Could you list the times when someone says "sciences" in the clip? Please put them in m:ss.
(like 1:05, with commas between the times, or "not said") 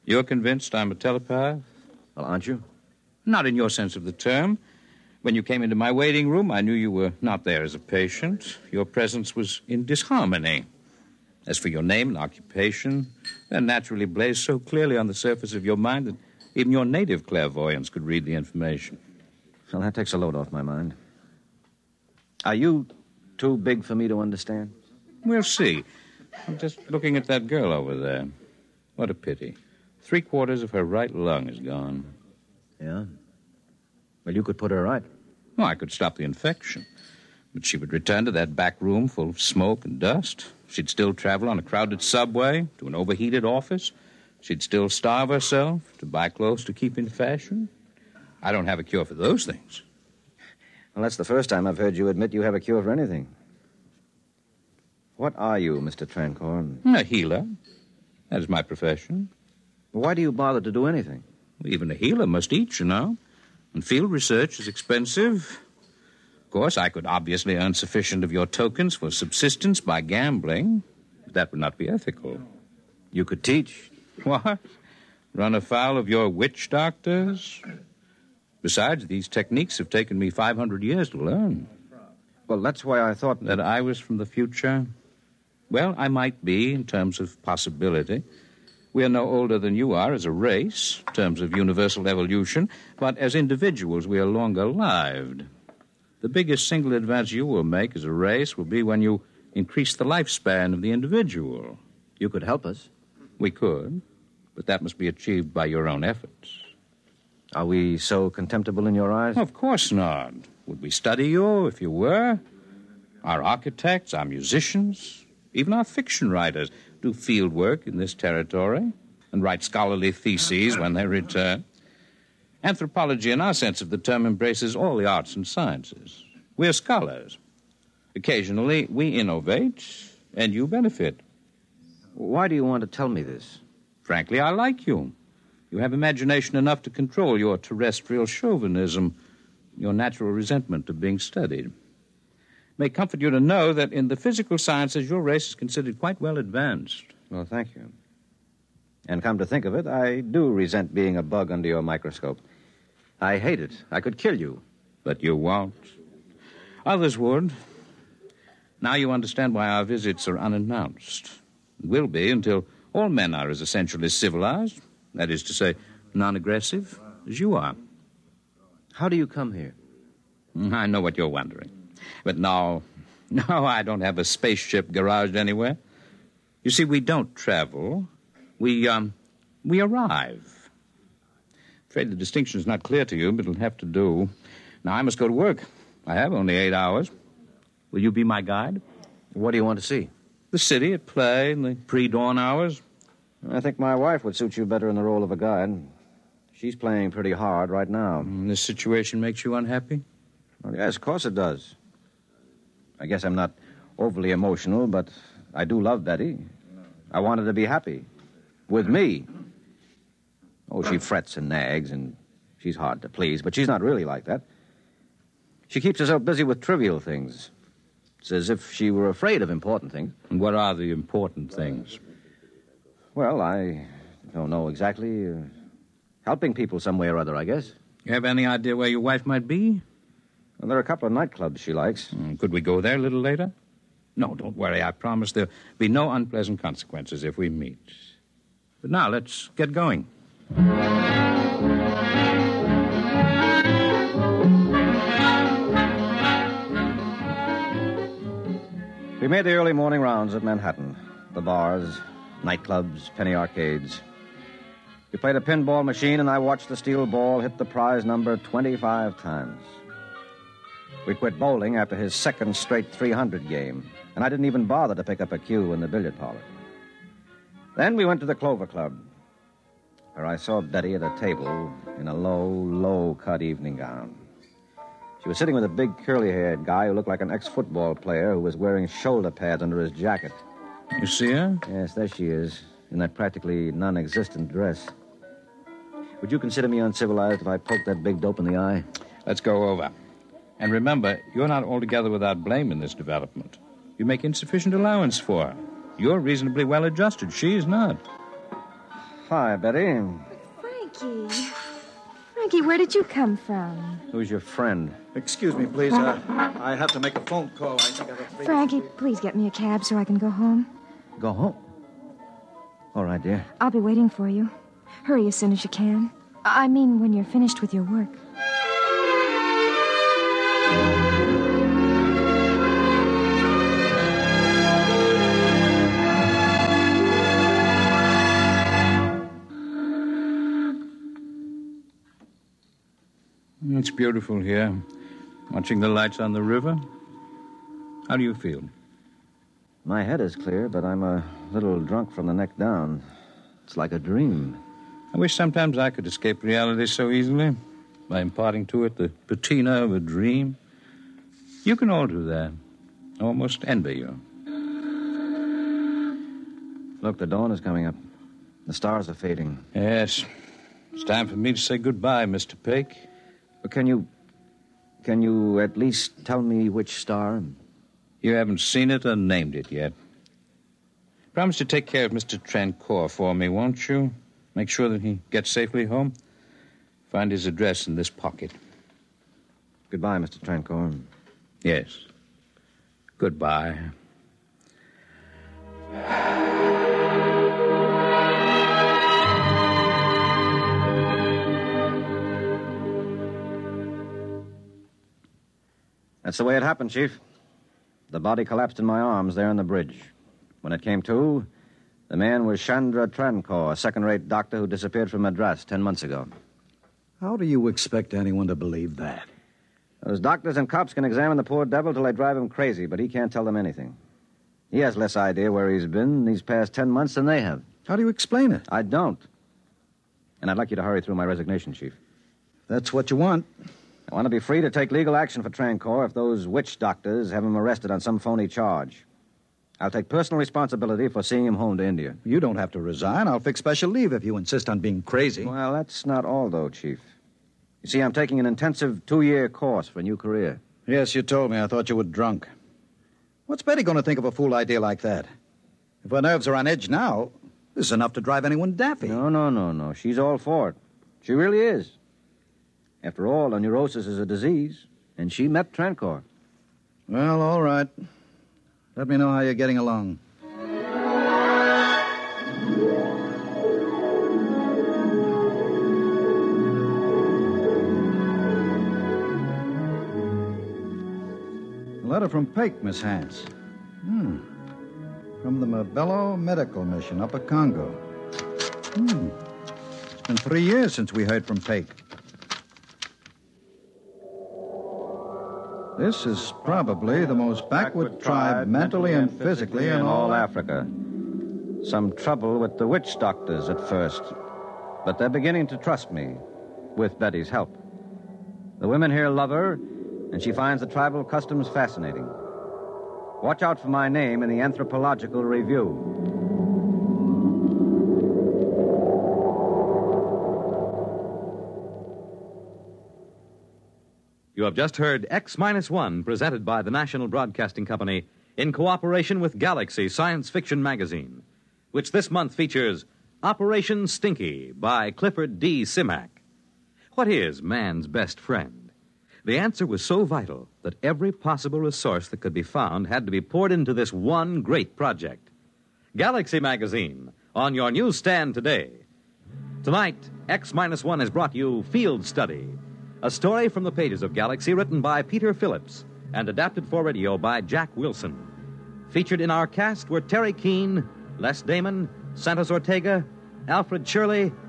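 2:05, 2:24, 8:40.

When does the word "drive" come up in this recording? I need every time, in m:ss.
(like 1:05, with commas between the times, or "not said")
6:52, 7:28.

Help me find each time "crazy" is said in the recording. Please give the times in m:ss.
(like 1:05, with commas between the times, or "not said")
6:52, 7:15.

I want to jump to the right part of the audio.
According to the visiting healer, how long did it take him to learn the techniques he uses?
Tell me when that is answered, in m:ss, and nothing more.
1:20.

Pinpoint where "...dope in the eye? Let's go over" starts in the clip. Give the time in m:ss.
4:48.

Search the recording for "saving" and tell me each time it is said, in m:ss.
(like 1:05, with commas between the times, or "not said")
not said.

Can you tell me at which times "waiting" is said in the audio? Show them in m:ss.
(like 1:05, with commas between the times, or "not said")
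0:05, 5:13.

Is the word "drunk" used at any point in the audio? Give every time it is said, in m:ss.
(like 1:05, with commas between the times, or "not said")
5:41, 7:22.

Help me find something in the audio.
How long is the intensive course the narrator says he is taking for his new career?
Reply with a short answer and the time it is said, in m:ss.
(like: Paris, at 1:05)
2 years, at 7:19.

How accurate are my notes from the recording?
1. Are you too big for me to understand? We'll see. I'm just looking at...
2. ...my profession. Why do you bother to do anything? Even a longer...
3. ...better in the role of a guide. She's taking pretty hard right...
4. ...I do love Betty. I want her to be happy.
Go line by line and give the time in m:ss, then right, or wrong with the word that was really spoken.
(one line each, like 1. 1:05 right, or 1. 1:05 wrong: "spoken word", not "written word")
1. 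0:22 right
2. 0:58 wrong: "healer", not "longer"
3. 3:14 wrong: "playing", not "taking"
4. 3:25 right.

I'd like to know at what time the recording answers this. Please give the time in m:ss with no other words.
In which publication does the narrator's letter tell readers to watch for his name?
8:24.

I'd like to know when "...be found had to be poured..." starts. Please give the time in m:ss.
8:52.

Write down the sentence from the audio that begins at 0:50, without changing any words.
Well, that's the first time I've heard you admit you have a cure for anything.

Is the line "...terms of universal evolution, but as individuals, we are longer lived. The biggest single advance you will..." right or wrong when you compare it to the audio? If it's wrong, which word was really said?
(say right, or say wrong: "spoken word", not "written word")
right.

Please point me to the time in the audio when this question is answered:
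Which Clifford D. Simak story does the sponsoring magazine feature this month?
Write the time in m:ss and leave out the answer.
8:43.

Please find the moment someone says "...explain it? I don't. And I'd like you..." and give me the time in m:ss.
6:58.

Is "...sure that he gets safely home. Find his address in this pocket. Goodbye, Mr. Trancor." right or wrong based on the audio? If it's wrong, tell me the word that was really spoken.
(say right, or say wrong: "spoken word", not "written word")
right.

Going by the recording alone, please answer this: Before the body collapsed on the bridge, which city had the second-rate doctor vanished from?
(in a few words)
Madras.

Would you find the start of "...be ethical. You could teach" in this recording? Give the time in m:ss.
1:11.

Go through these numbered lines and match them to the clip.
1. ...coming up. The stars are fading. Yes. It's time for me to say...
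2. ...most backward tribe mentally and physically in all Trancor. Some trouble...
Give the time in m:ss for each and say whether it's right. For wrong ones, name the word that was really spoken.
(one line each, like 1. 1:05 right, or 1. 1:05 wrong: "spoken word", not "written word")
1. 5:57 right
2. 8:07 wrong: "Africa", not "Trancor".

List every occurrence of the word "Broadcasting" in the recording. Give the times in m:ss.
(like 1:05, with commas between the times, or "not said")
8:37.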